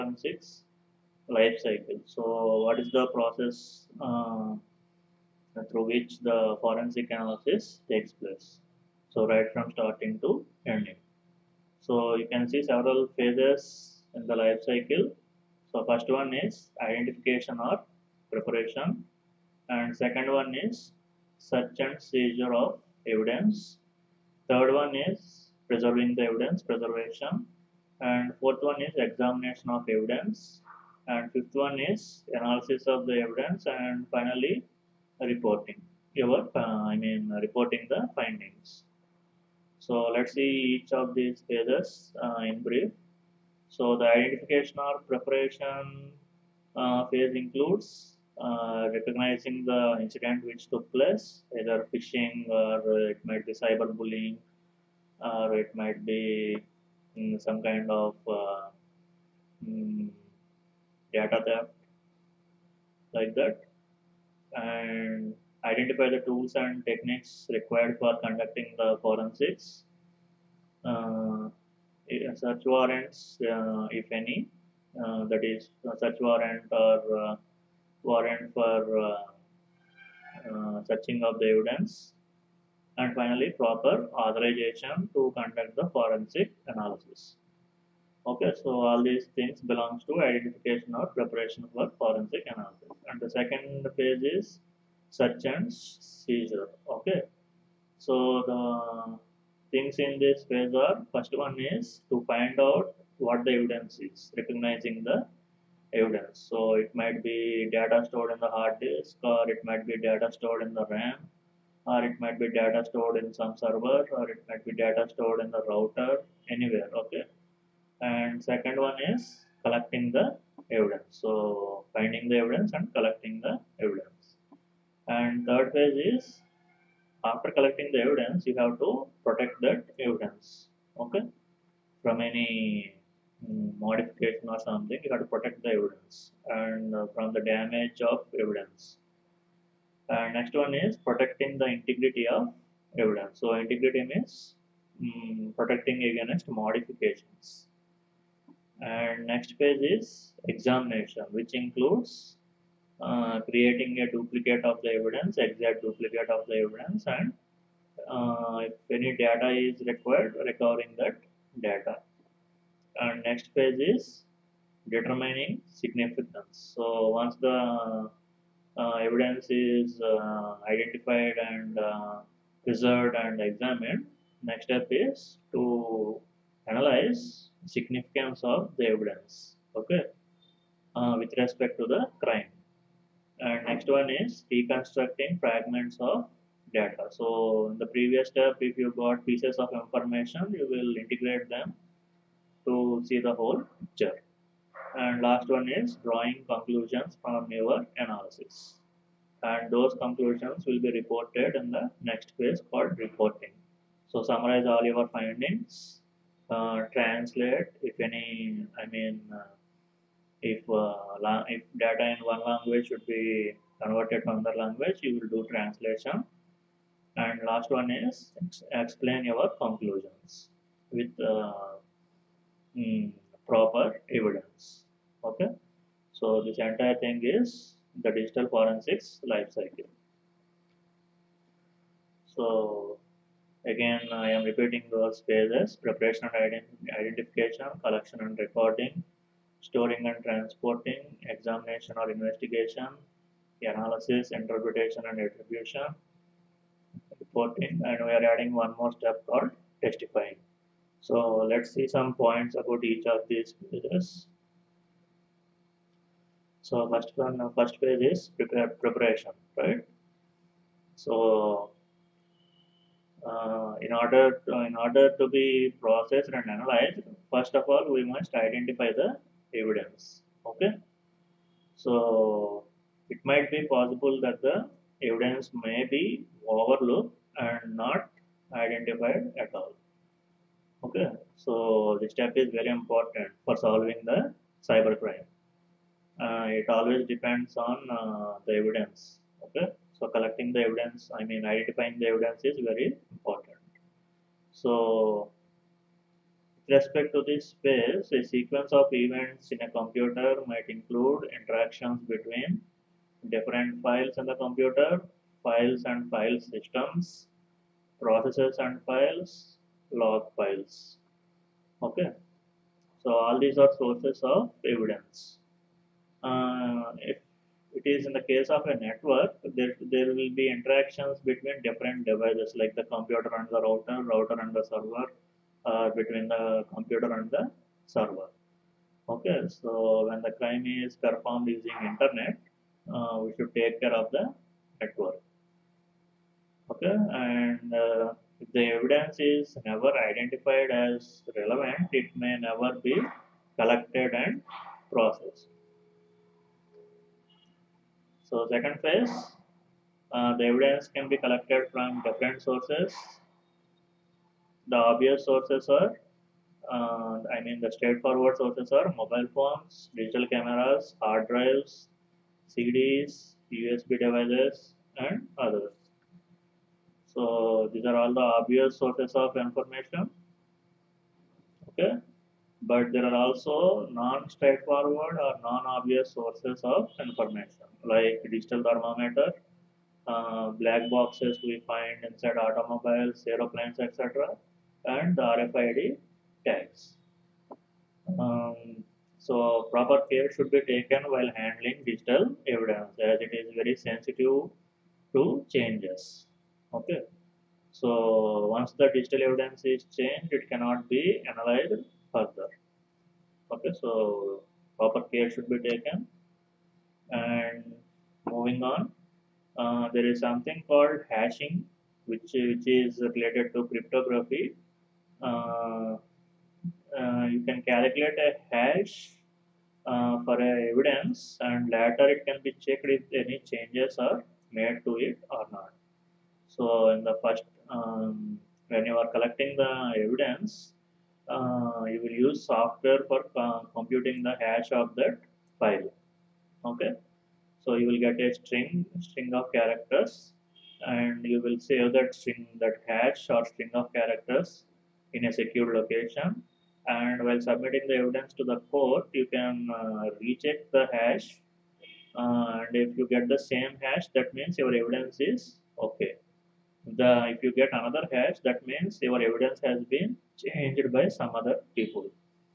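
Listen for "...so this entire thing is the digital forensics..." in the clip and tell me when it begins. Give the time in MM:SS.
03:46.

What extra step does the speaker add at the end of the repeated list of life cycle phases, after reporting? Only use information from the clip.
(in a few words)
testifying.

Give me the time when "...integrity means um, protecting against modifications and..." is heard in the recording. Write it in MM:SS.
02:23.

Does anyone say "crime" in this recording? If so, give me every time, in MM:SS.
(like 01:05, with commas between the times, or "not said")
03:02, 05:30.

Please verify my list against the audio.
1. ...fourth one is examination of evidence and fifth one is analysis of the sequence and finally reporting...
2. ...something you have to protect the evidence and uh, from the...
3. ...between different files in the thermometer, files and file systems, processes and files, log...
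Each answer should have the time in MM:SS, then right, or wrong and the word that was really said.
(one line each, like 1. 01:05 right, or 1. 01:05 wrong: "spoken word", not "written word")
1. 00:28 wrong: "evidence", not "sequence"
2. 02:14 right
3. 05:02 wrong: "computer", not "thermometer".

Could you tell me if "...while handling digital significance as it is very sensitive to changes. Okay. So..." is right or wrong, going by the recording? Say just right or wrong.
wrong.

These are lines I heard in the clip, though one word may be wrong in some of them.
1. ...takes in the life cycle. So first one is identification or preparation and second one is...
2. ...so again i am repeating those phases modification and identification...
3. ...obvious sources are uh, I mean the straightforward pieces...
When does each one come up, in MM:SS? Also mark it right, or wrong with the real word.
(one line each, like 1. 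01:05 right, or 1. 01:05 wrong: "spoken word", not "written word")
1. 00:13 wrong: "phases", not "takes"
2. 03:52 wrong: "preparation", not "modification"
3. 05:54 wrong: "sources", not "pieces".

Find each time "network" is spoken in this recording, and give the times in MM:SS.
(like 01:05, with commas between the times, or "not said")
05:18, 05:34.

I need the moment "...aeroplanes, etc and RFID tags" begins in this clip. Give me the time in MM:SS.
06:23.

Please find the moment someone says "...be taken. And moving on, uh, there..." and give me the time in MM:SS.
06:45.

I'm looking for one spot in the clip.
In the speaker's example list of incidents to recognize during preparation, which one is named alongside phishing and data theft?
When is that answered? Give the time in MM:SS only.
00:53.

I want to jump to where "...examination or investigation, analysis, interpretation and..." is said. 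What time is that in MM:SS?
04:01.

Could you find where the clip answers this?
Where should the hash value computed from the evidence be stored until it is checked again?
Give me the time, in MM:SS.
07:25.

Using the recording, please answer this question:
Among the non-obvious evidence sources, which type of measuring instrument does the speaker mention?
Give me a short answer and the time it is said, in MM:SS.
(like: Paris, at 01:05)
digital thermometer, at 06:18.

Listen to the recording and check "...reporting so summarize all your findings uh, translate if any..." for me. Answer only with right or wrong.
right.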